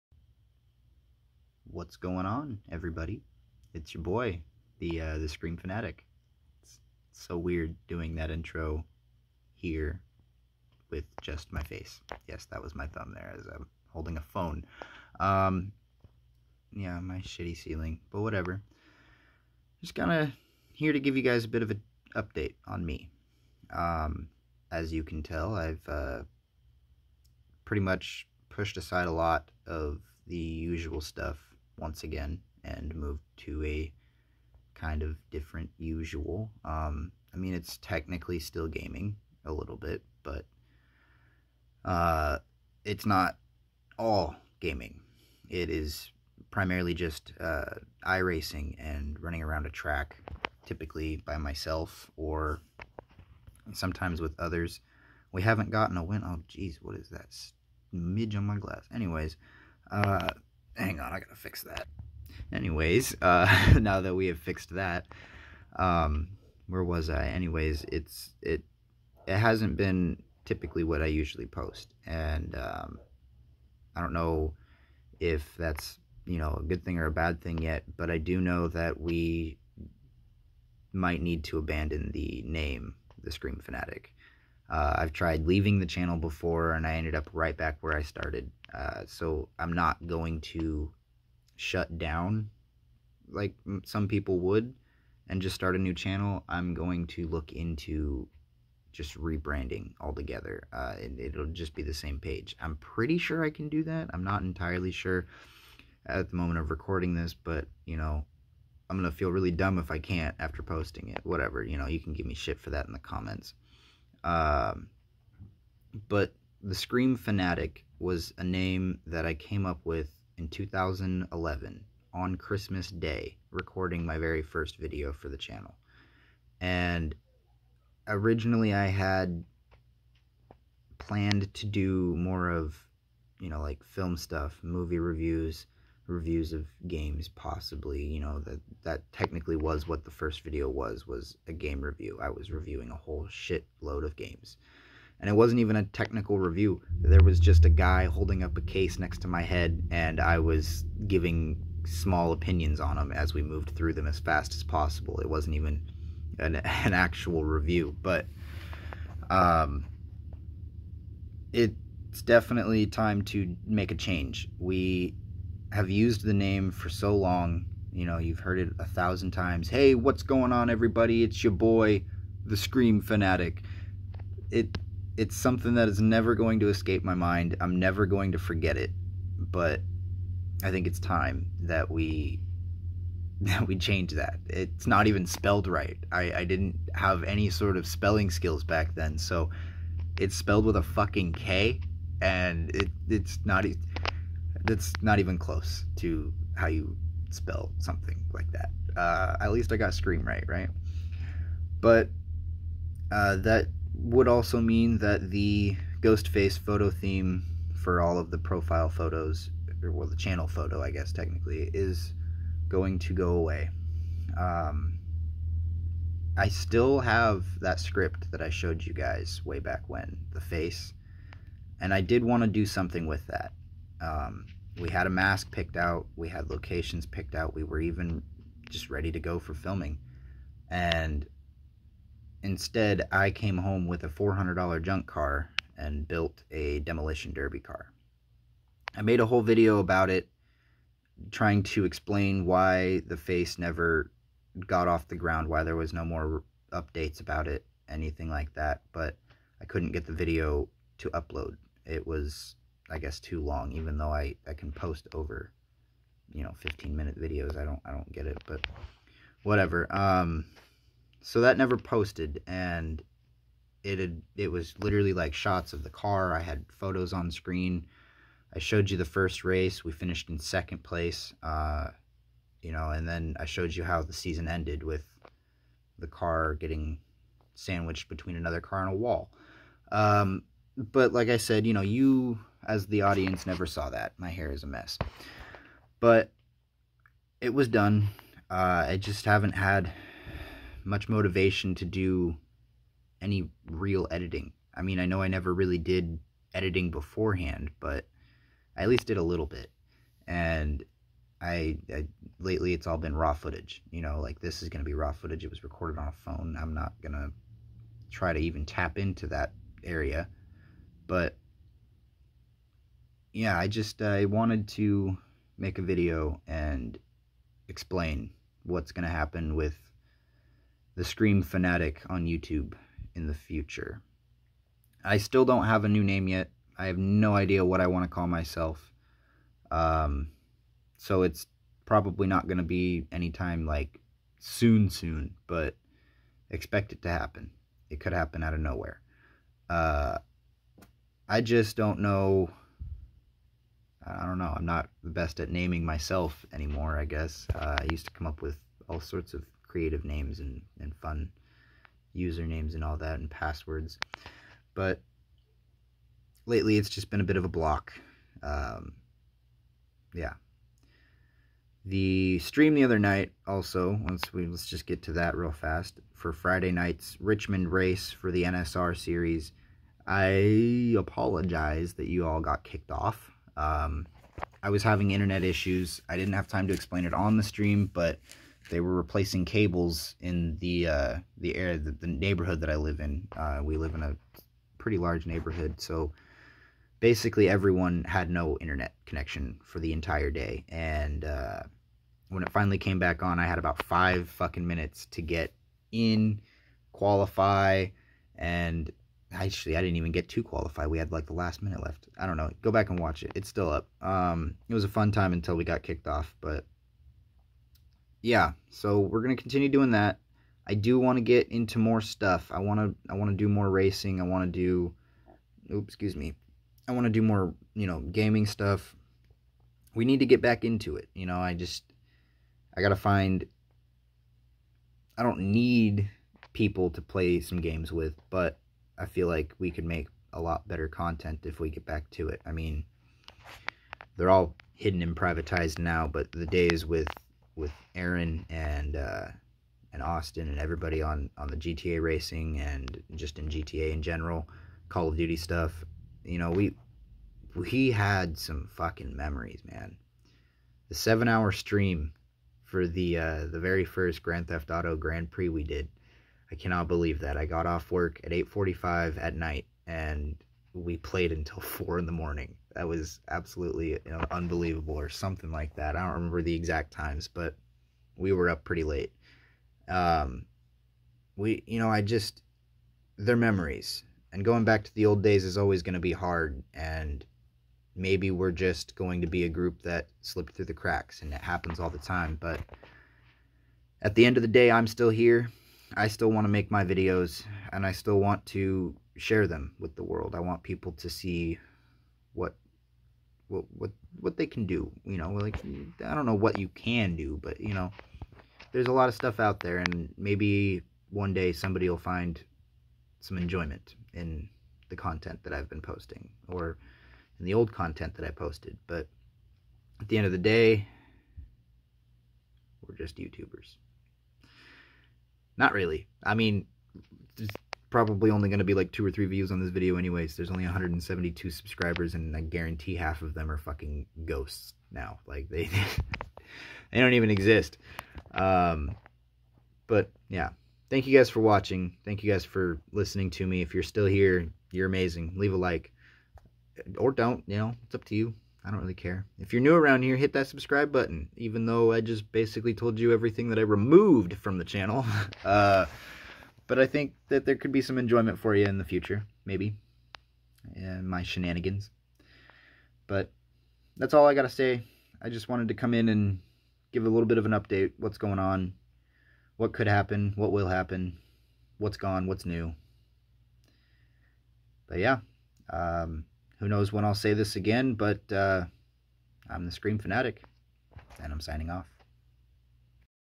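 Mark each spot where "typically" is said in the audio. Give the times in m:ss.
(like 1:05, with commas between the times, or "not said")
0:50, 1:10.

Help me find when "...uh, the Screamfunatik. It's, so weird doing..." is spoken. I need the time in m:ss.
0:04.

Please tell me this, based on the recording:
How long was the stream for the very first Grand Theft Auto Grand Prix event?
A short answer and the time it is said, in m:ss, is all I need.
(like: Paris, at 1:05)
7 hours, at 7:30.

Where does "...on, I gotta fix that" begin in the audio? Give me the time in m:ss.
1:00.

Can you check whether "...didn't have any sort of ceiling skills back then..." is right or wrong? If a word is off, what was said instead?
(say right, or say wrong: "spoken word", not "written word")
wrong: "spelling", not "ceiling".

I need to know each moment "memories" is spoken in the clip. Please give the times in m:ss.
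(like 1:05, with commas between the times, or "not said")
7:29, 7:53.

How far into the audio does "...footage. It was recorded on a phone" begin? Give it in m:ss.
5:05.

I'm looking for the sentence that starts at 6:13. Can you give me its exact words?
Um, I was having internet issues.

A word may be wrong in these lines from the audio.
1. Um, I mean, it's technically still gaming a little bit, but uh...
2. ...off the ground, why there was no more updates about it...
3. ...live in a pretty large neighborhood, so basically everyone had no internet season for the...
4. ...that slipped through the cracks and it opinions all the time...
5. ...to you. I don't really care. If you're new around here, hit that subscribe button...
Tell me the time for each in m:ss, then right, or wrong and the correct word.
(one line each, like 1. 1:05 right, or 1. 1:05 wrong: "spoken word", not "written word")
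1. 0:36 right
2. 4:04 right
3. 6:23 wrong: "connection", not "season"
4. 7:59 wrong: "happens", not "opinions"
5. 8:58 right.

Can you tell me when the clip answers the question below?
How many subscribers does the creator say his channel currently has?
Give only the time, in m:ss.
8:40.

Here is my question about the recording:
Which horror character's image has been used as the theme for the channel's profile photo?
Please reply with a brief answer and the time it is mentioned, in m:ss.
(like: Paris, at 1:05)
Ghostface, at 3:26.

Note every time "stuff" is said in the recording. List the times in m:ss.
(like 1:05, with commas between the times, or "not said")
0:30, 2:14, 6:52, 6:58, 7:25, 8:19.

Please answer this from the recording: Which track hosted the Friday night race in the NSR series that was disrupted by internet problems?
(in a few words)
Richmond.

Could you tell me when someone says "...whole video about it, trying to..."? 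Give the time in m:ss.
3:59.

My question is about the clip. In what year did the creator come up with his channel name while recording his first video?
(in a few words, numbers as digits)
2011.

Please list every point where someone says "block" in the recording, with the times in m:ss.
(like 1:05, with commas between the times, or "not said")
5:57.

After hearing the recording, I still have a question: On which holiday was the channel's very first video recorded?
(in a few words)
Christmas Day.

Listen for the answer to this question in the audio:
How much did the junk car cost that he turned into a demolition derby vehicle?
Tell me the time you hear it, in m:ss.
3:54.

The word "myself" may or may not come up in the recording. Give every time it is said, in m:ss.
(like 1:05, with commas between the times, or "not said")
0:51, 5:28, 5:45.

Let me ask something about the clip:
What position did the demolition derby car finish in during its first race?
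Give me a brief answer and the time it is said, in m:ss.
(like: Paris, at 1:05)
Second place, at 4:30.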